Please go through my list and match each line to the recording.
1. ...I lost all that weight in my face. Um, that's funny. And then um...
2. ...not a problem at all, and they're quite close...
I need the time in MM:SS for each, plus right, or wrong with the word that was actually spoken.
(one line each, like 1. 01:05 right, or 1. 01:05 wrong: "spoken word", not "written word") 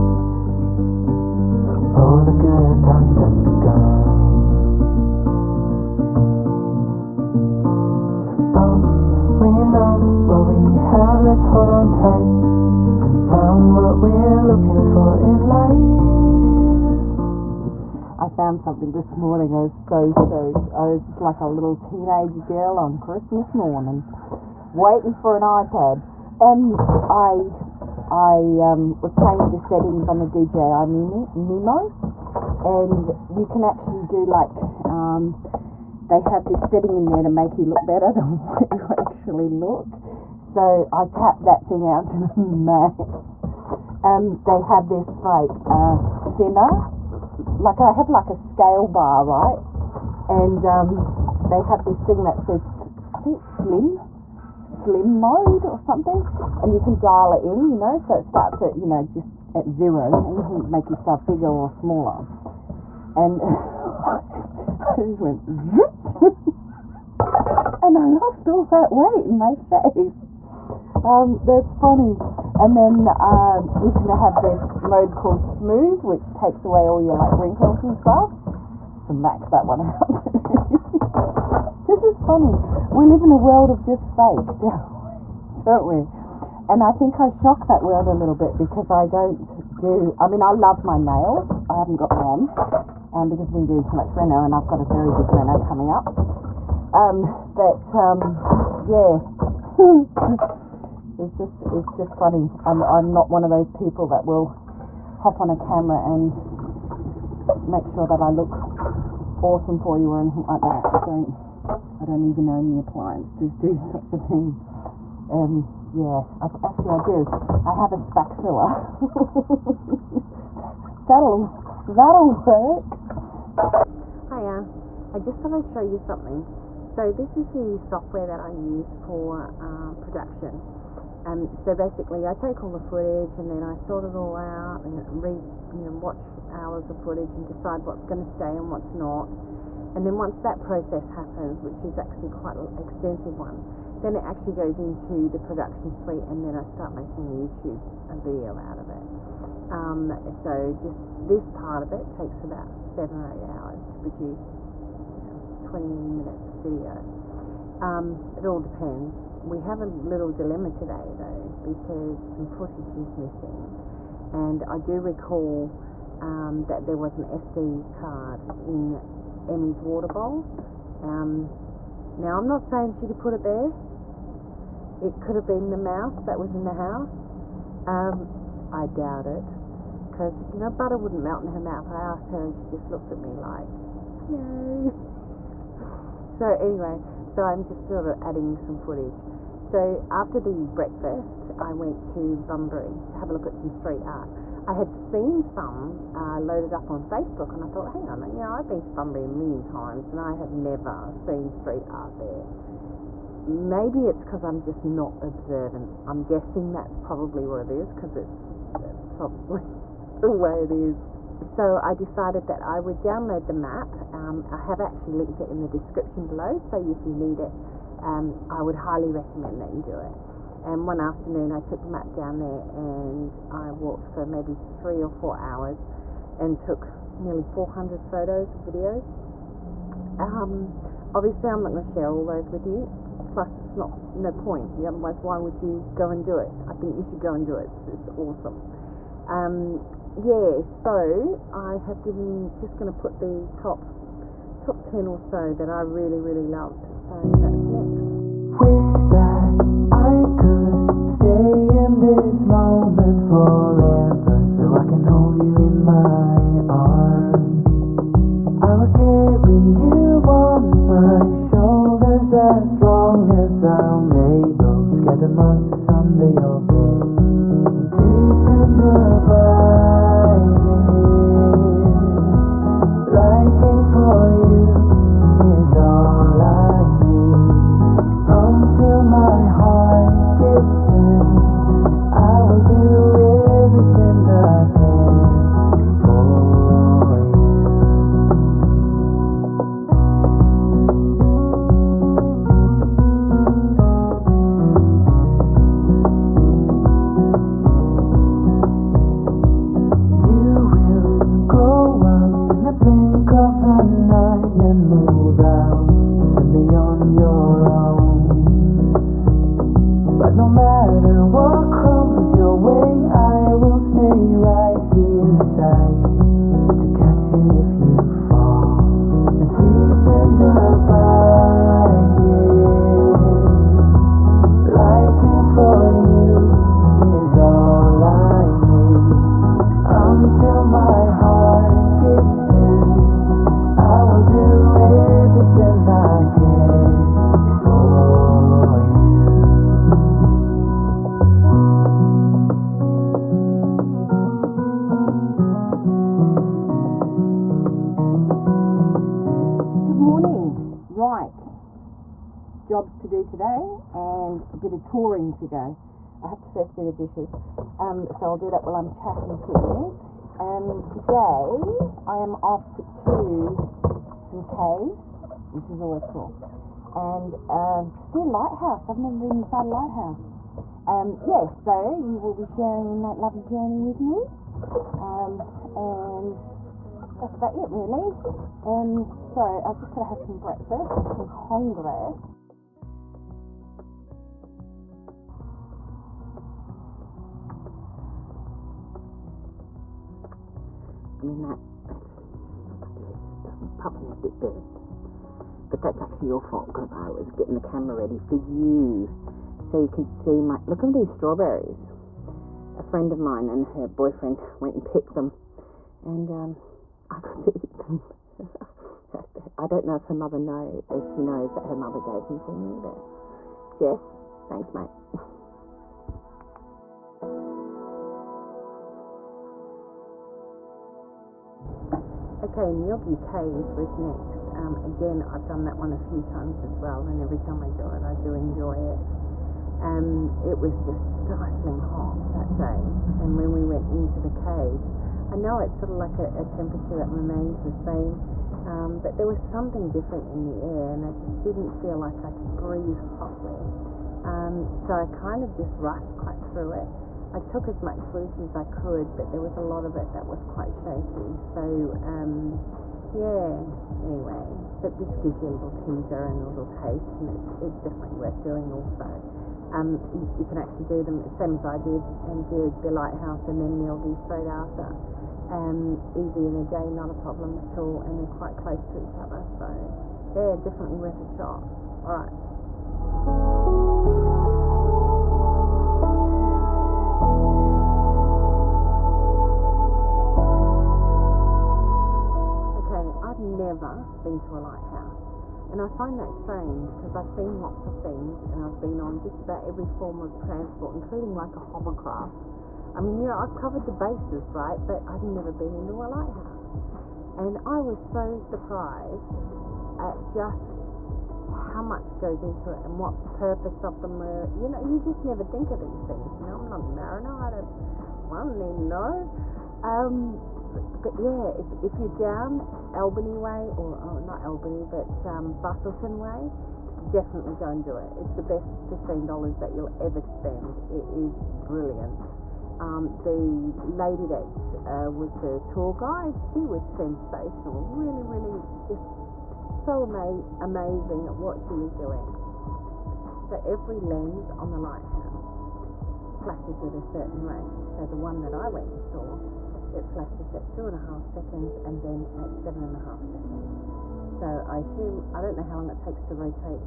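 1. 01:07 right
2. 07:46 right.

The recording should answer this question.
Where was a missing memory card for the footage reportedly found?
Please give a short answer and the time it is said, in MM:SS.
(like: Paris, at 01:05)
Emmie's water bowl, at 02:49.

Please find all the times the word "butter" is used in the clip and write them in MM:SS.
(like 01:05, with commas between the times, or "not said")
03:00.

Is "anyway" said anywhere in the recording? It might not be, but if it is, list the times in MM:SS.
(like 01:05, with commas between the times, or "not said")
03:06, 07:34.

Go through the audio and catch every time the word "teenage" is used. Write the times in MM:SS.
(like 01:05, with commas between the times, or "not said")
00:21.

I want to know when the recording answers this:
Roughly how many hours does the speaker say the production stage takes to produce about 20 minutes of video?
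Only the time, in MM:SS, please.
02:32.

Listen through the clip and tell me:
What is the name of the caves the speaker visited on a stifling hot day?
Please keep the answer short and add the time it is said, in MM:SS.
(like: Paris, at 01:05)
Ngilgi Caves, at 07:02.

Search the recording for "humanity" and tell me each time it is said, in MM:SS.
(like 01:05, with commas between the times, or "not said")
not said.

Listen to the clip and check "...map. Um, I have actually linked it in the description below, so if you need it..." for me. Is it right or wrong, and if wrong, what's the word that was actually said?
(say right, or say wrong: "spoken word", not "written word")
right.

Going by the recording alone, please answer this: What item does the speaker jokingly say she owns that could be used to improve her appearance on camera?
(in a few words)
Spack filler.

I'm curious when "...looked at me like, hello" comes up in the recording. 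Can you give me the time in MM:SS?
03:02.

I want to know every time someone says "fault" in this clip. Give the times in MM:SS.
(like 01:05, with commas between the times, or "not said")
06:36.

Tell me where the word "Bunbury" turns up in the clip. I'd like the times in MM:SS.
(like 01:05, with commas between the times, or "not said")
03:12, 03:18.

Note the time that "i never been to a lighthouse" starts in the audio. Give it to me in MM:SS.
08:03.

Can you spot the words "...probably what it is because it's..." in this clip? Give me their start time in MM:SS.
03:26.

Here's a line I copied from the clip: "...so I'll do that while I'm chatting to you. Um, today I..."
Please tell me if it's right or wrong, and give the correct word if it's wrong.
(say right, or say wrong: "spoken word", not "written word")
right.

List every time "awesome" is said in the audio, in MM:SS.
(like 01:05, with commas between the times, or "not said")
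01:49, 03:58.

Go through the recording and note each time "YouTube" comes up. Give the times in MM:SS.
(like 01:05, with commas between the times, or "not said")
02:27.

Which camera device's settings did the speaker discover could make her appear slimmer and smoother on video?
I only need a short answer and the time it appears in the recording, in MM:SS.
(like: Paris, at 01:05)
DJI Mimo, at 00:30.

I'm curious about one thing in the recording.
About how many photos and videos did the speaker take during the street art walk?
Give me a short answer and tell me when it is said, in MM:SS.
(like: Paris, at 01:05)
Nearly 400, at 03:47.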